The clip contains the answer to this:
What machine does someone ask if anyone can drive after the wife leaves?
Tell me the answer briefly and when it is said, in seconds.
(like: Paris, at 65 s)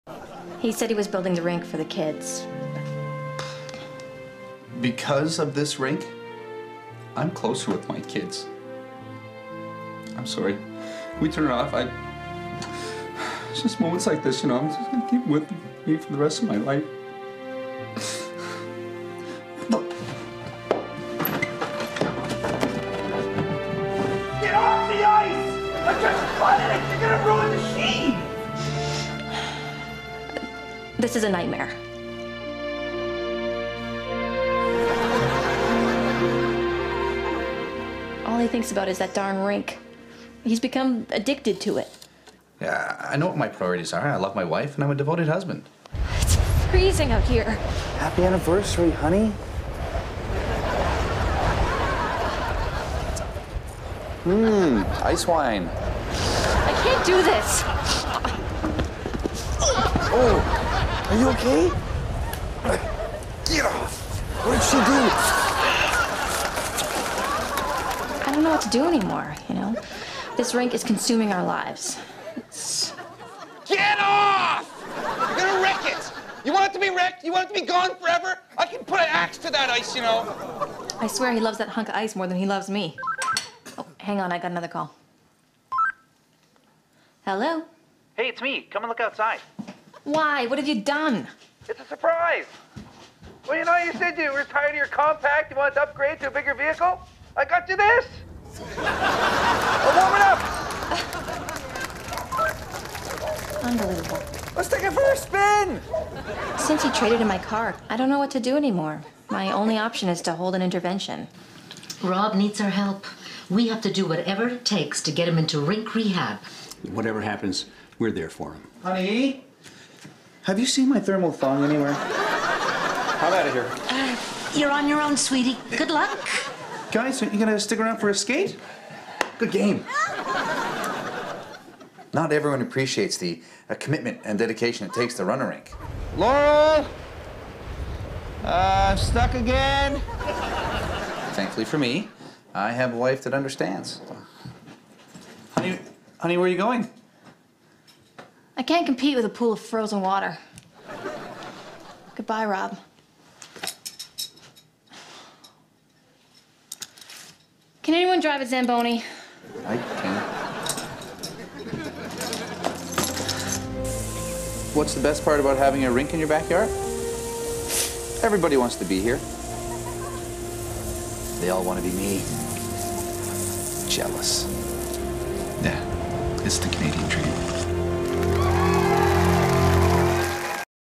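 Zamboni, at 158 s.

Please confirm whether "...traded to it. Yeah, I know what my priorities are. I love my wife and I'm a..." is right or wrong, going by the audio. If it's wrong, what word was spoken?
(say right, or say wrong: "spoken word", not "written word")
wrong: "addicted", not "traded".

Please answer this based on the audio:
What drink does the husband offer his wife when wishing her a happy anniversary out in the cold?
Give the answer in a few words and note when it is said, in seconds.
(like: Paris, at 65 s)
Ice wine, at 55 s.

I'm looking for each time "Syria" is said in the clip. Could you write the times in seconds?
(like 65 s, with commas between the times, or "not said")
not said.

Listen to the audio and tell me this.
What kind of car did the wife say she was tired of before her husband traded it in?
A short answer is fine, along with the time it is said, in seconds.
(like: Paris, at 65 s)
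Compact, at 94 s.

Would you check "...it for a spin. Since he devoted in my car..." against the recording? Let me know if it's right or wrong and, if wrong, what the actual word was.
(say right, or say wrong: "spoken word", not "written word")
wrong: "traded", not "devoted".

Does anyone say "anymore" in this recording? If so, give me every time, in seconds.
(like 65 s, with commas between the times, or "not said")
68 s, 108 s.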